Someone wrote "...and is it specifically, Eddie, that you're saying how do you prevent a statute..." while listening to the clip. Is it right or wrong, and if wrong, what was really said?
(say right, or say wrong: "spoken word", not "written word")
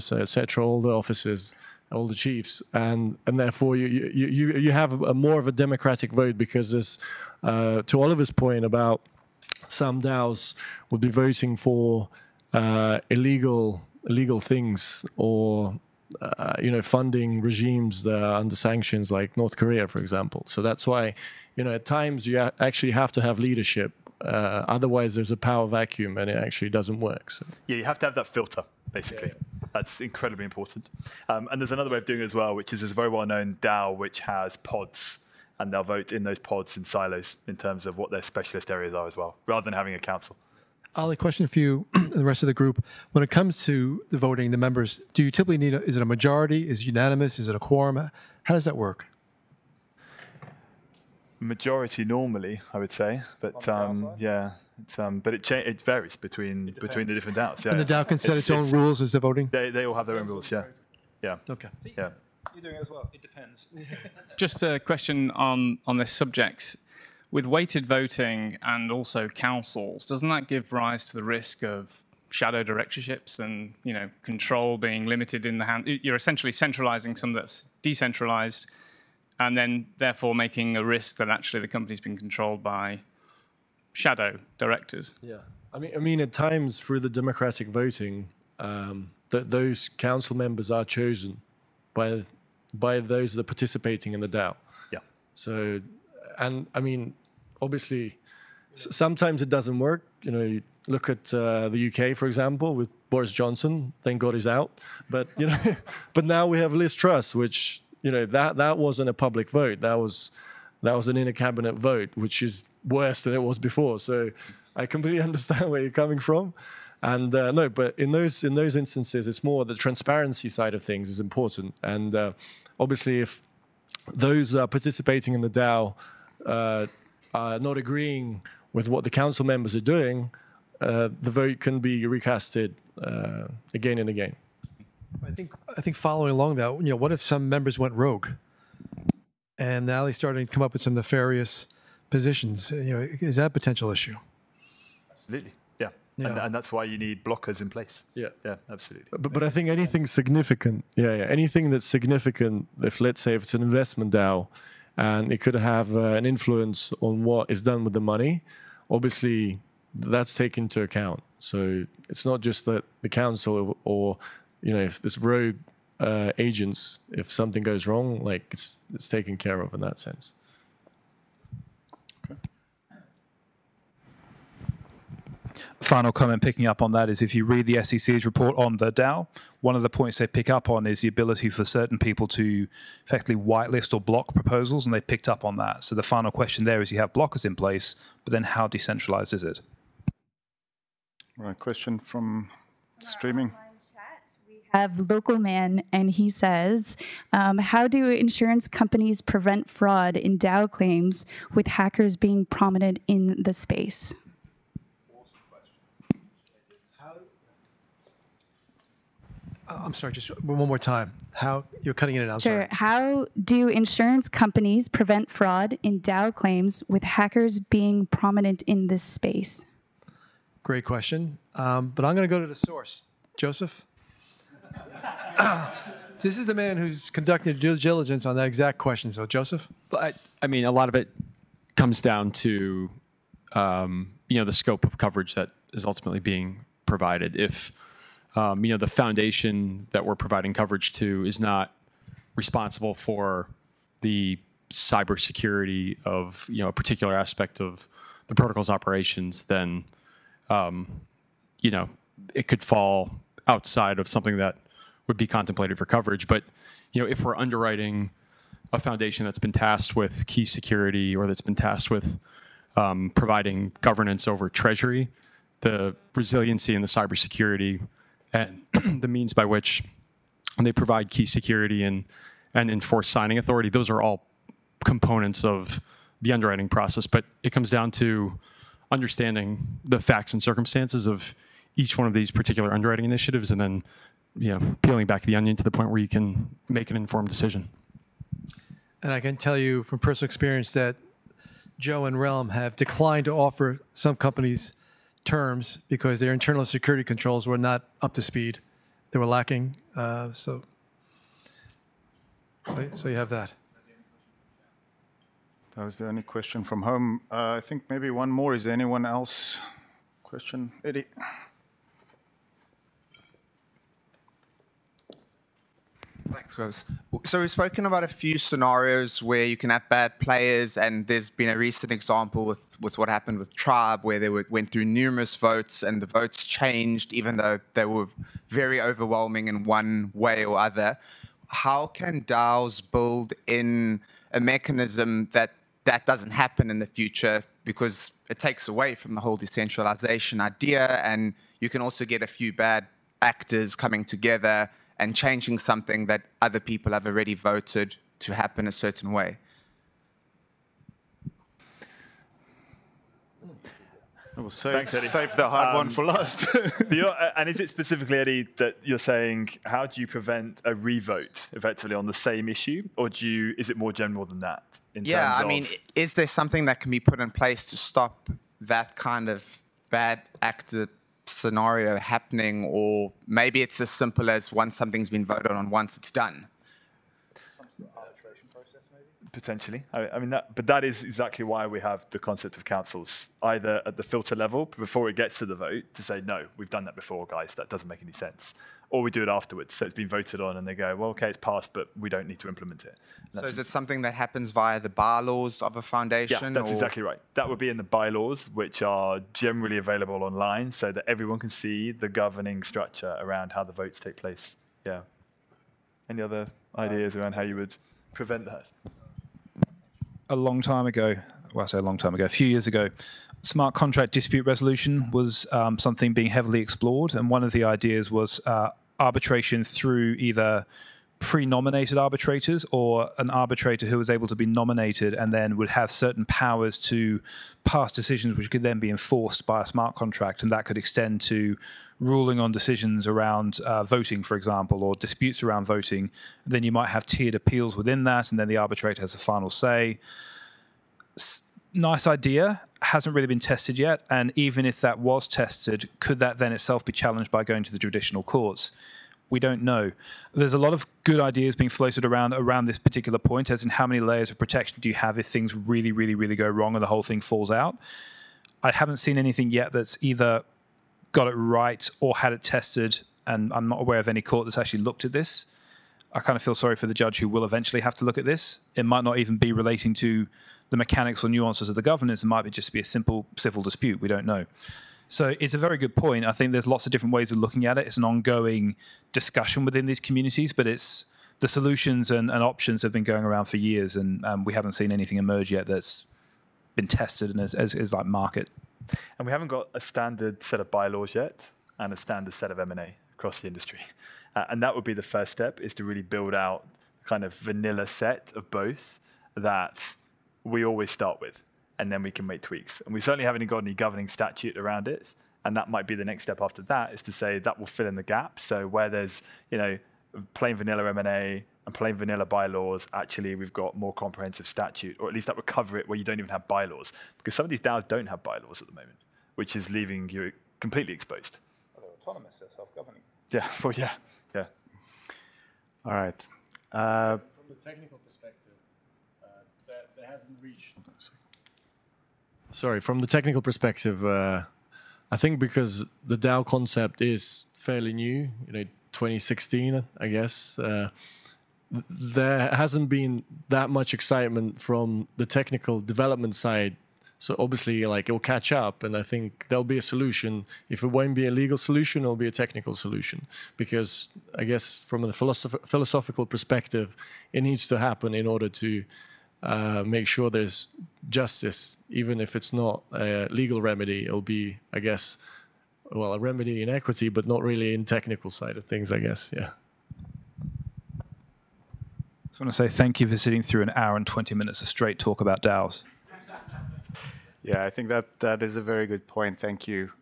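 wrong: "revote", not "statute".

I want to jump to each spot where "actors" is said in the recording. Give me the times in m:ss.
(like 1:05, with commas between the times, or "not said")
5:43, 6:10.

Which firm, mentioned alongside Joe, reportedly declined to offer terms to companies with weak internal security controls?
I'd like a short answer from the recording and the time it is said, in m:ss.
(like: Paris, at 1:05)
Realm, at 4:52.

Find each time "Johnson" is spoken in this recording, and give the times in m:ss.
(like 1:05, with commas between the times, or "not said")
1:43.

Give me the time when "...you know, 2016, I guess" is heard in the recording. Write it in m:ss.
8:58.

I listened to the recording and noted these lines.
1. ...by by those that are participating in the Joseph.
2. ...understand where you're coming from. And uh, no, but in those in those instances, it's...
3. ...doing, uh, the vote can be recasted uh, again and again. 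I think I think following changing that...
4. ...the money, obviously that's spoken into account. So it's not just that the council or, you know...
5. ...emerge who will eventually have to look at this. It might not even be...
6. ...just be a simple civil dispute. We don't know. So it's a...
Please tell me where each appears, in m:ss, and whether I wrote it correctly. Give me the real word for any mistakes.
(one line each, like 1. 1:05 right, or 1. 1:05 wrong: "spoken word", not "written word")
1. 1:31 wrong: "DAO", not "Joseph"
2. 1:55 right
3. 2:09 wrong: "along", not "changing"
4. 2:37 wrong: "taken", not "spoken"
5. 7:46 wrong: "judge", not "emerge"
6. 7:52 right.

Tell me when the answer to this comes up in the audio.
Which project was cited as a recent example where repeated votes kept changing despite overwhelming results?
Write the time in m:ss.
5:23.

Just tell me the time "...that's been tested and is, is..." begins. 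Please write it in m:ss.
8:05.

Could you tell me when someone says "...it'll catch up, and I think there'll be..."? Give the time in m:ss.
9:08.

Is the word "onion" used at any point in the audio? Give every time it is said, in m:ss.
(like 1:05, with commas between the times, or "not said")
4:45.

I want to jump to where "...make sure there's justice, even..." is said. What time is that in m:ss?
9:19.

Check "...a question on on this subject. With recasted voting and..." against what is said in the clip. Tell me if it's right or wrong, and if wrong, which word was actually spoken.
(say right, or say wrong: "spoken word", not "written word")
wrong: "weighted", not "recasted".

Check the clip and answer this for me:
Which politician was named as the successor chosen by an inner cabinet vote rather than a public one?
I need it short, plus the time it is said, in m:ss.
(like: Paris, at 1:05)
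Liz Truss, at 1:46.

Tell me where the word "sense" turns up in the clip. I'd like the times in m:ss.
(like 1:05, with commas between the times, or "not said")
2:49, 6:28.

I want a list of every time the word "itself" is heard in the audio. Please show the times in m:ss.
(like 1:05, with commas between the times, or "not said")
7:26.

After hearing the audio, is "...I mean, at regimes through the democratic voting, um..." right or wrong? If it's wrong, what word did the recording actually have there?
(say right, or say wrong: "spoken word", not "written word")
wrong: "times", not "regimes".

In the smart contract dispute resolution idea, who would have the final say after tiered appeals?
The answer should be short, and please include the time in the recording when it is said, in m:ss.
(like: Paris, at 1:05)
The arbitrator, at 7:18.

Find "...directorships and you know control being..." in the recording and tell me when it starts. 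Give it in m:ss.
1:12.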